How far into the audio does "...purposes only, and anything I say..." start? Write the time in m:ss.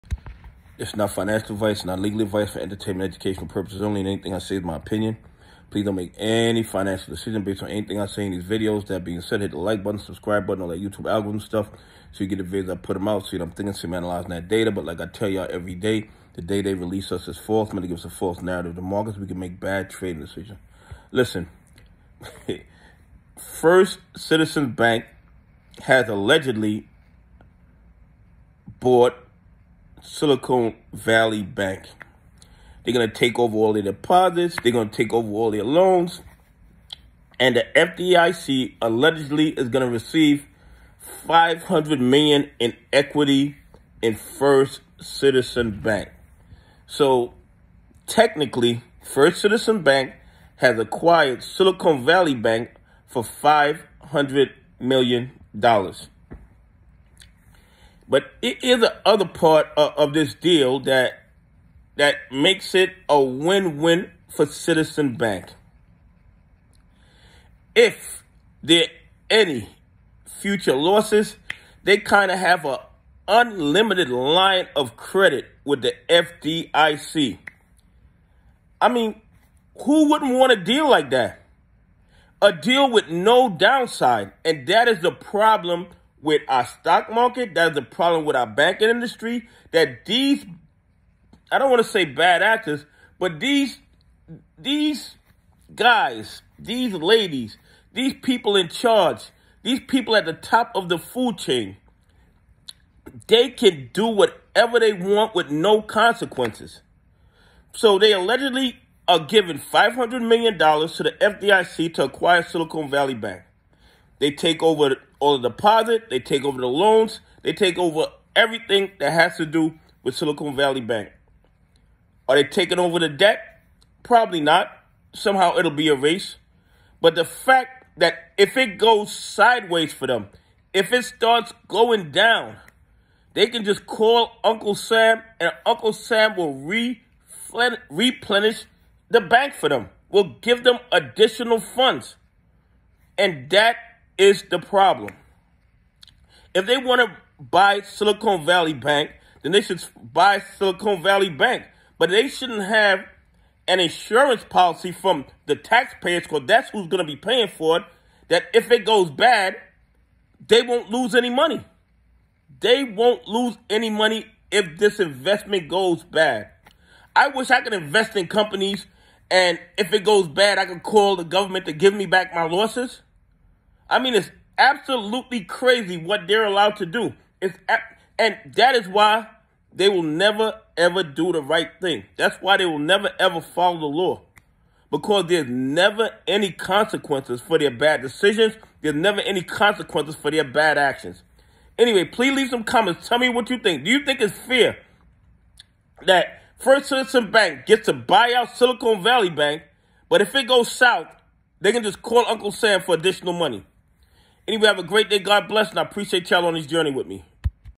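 0:03.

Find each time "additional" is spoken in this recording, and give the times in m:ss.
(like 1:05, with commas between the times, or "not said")
2:20, 3:22.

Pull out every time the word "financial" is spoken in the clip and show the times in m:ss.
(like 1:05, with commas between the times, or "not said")
0:01, 0:06.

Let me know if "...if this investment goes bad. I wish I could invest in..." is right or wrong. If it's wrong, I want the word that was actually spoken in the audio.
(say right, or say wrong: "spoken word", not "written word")
right.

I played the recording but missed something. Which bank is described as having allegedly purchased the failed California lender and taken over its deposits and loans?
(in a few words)
First Citizens Bank.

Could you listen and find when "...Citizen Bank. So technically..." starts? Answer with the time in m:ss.
0:44.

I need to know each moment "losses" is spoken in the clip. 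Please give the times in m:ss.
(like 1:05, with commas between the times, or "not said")
1:10, 2:52.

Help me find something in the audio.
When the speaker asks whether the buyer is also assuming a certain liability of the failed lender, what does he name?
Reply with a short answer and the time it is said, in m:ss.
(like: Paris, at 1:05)
the debt, at 2:02.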